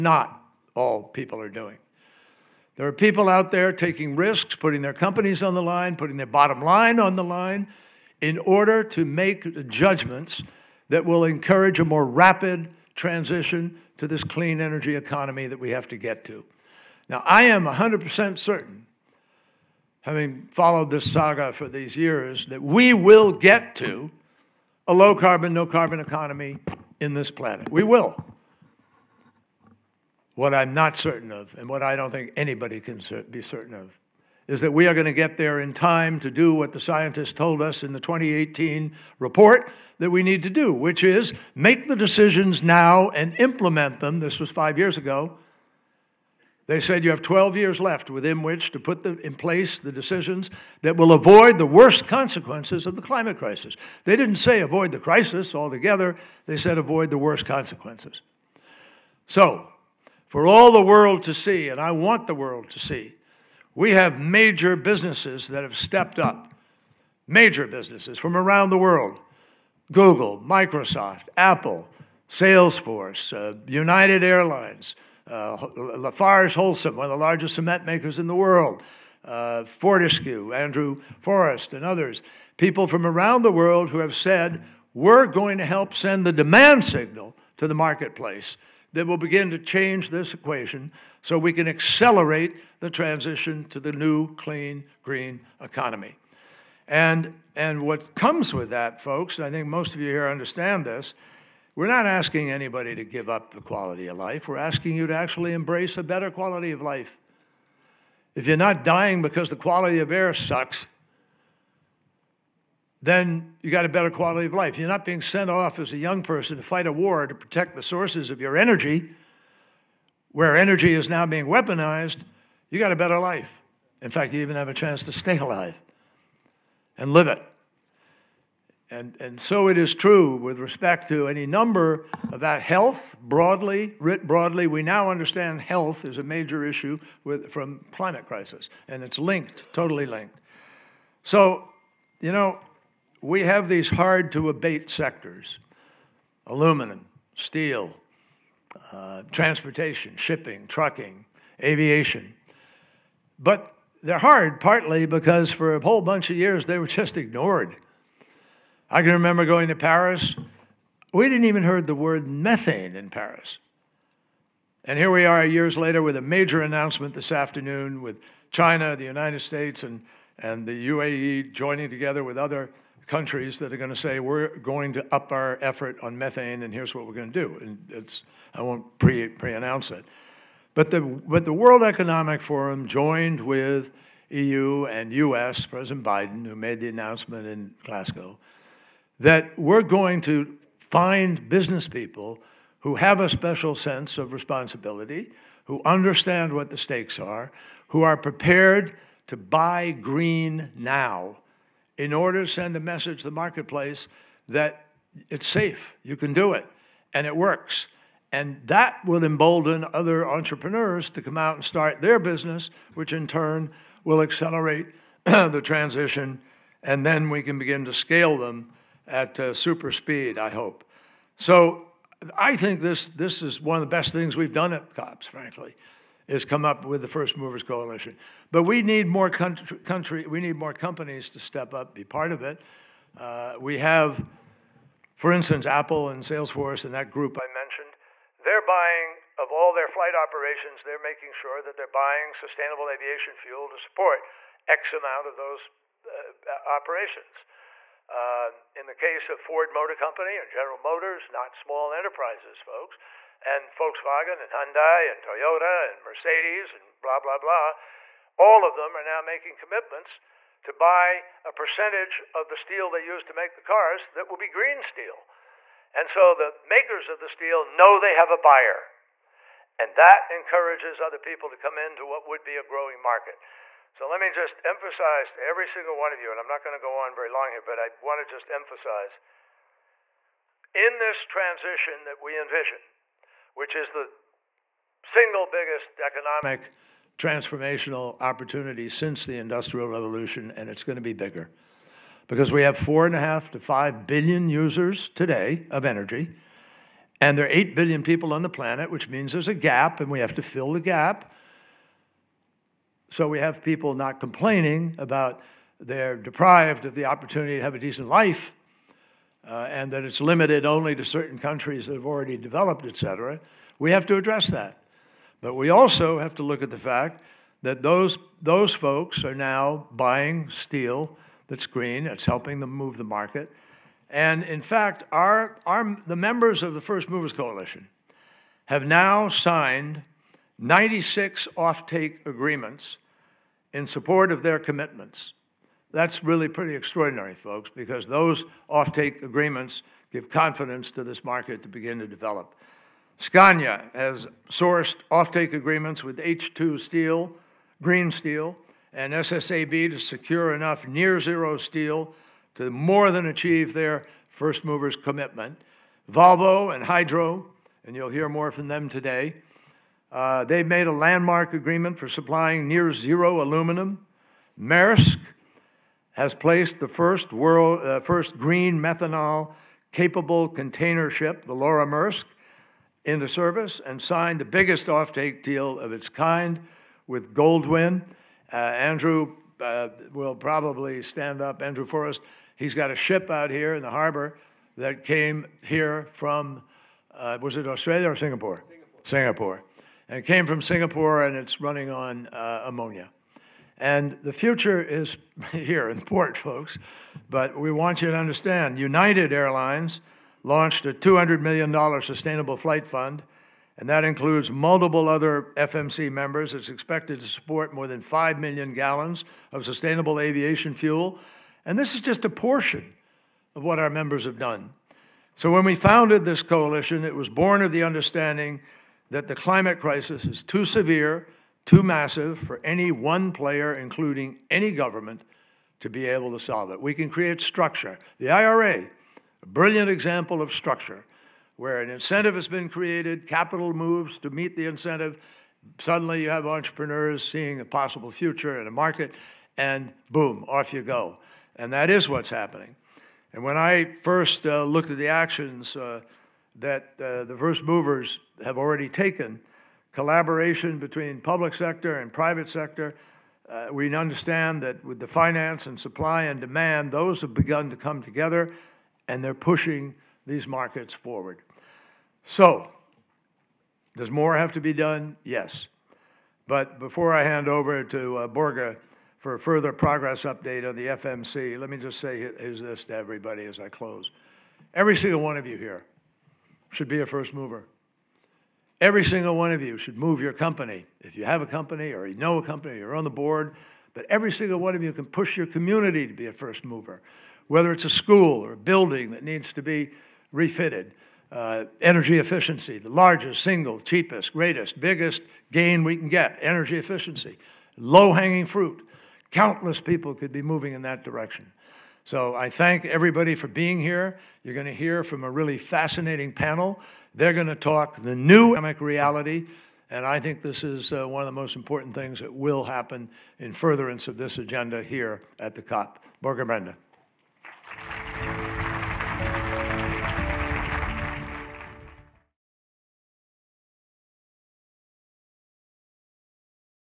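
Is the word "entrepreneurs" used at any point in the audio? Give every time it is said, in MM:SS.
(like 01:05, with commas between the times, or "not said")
03:30, 07:16.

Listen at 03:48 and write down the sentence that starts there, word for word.
But we need more country, country we need more companies to step up, be part of it.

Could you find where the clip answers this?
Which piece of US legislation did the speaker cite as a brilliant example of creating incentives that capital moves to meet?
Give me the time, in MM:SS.
07:08.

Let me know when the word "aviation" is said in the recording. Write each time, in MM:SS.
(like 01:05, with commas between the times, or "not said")
02:31, 04:02, 06:50.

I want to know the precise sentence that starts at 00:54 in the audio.
They didn't say avoid the crisis altogether, they said avoid the worst consequences.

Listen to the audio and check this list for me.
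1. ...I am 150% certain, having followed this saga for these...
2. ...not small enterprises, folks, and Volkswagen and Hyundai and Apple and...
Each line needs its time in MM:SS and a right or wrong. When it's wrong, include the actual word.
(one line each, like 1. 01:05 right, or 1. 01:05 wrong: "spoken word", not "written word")
1. 00:17 wrong: "100", not "150"
2. 04:11 wrong: "Toyota", not "Apple".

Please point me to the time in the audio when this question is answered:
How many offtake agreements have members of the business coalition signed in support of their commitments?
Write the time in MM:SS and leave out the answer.
05:30.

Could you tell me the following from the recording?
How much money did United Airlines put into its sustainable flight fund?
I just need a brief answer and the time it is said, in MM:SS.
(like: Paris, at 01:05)
$200 million, at 06:40.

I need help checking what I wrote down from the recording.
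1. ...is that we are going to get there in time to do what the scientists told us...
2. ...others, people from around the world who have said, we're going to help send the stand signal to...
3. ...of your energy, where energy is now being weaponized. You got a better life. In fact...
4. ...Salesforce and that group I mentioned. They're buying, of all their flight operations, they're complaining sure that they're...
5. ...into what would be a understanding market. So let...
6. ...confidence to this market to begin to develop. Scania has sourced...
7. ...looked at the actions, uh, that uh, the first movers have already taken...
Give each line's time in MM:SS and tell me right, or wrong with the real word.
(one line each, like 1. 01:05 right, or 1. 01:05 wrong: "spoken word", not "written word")
1. 00:34 right
2. 01:21 wrong: "demand", not "stand"
3. 01:58 right
4. 03:56 wrong: "making", not "complaining"
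5. 04:31 wrong: "growing", not "understanding"
6. 05:40 right
7. 07:24 right.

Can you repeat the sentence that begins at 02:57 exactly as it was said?
And it's, I won't pre, pre-announce it.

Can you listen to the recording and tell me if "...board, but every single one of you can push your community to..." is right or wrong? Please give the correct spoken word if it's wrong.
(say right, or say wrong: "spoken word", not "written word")
right.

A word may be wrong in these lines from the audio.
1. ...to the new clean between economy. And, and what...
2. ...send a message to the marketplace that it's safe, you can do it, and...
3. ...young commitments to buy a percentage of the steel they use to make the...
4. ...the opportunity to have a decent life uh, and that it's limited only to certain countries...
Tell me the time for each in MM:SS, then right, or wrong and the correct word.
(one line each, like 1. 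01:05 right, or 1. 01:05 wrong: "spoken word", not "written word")
1. 01:33 wrong: "green", not "between"
2. 03:22 right
3. 04:19 wrong: "making", not "young"
4. 05:06 right.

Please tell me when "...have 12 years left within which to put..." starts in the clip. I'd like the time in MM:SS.
00:47.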